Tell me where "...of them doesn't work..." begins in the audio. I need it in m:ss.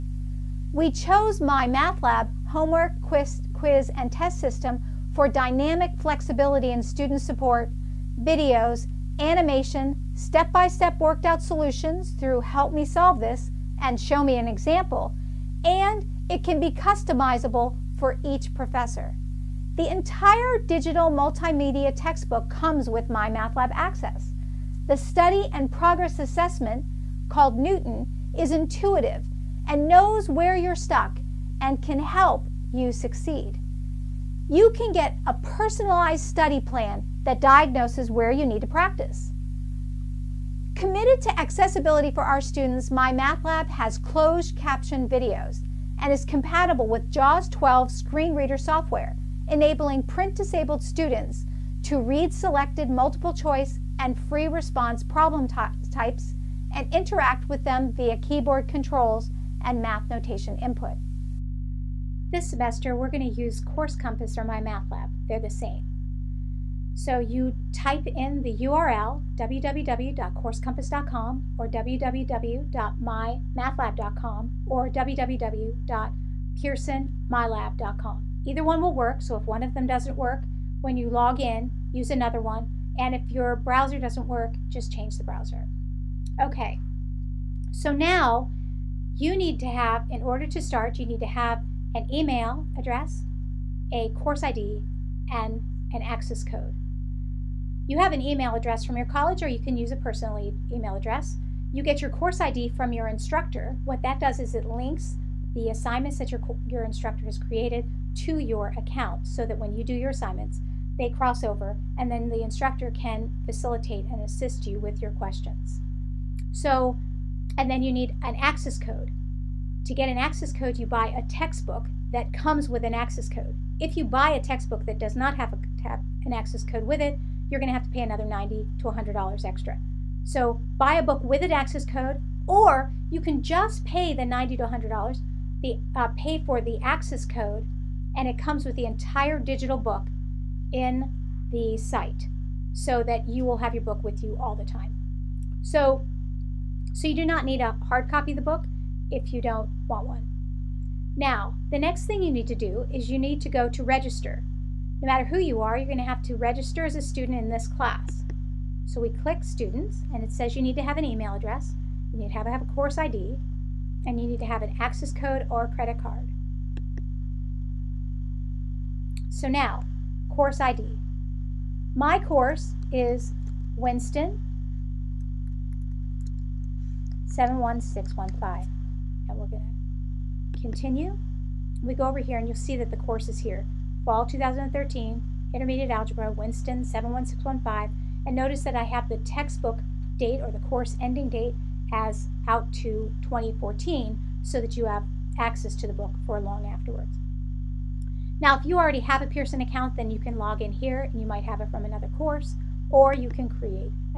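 1:19.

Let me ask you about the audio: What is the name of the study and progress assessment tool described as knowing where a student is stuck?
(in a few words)
Knewton.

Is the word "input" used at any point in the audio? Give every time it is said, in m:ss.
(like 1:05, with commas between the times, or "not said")
1:00.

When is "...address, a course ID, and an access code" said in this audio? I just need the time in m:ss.
1:32.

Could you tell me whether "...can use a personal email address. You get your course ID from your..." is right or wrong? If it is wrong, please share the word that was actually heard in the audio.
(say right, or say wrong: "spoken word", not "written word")
right.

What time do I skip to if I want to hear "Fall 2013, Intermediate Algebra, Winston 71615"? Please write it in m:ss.
3:04.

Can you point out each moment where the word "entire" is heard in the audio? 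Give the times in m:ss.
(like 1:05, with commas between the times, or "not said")
0:19, 2:18.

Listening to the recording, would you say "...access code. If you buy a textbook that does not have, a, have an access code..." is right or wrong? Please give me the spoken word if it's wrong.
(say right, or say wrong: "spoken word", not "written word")
right.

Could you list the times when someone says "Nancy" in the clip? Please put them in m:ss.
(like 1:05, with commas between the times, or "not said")
not said.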